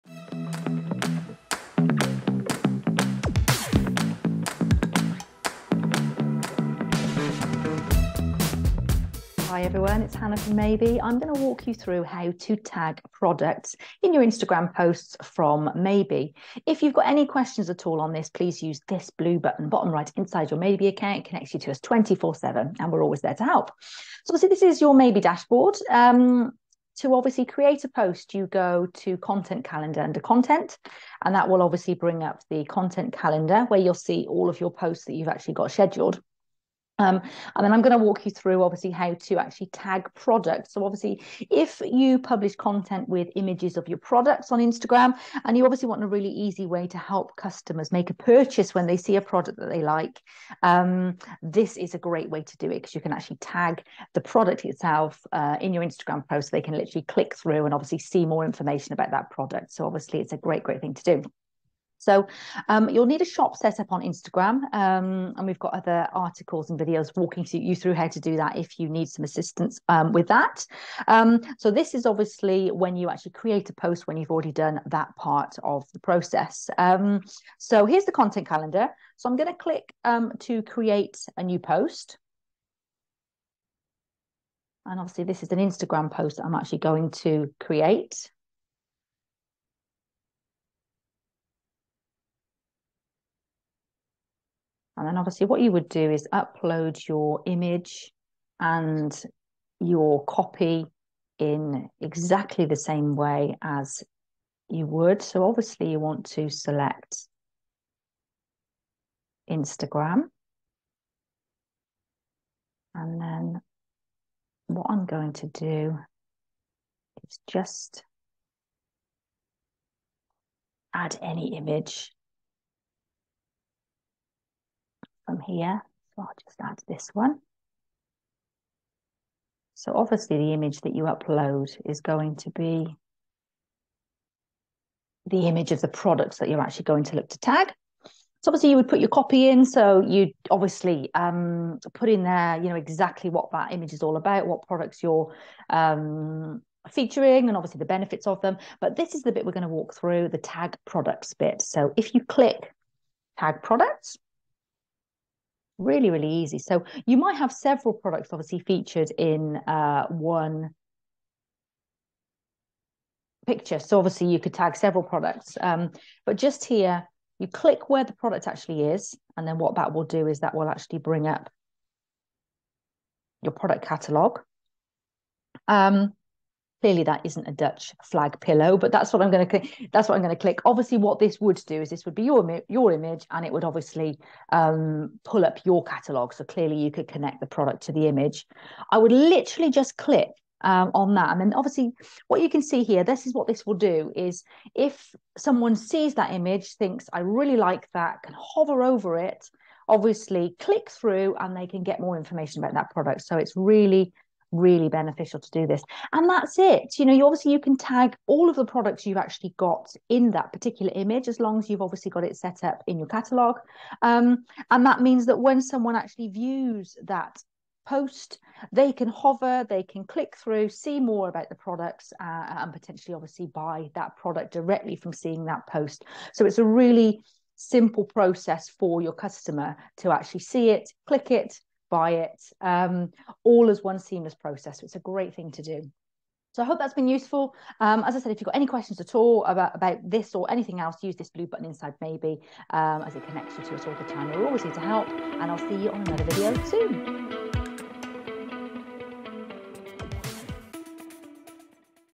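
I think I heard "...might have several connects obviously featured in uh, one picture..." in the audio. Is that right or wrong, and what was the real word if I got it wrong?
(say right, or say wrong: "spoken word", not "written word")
wrong: "products", not "connects".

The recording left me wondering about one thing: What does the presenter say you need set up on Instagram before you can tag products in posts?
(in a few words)
A shop.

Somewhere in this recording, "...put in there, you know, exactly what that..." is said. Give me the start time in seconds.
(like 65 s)
141 s.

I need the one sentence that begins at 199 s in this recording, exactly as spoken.
Obviously, click through and they can get more information about that product.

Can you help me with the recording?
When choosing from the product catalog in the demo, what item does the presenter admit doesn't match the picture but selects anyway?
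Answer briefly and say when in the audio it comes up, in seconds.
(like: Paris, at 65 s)
Dutch flag pillow, at 177 s.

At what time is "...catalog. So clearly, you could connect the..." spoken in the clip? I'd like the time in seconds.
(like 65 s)
185 s.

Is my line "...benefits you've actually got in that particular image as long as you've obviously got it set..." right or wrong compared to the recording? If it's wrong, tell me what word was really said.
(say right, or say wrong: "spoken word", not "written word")
wrong: "products", not "benefits".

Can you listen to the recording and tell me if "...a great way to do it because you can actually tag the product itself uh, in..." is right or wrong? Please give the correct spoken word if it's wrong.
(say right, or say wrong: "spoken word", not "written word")
right.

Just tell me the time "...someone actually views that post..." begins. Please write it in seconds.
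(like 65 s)
215 s.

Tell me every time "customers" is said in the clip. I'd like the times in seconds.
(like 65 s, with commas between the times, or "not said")
47 s, 229 s.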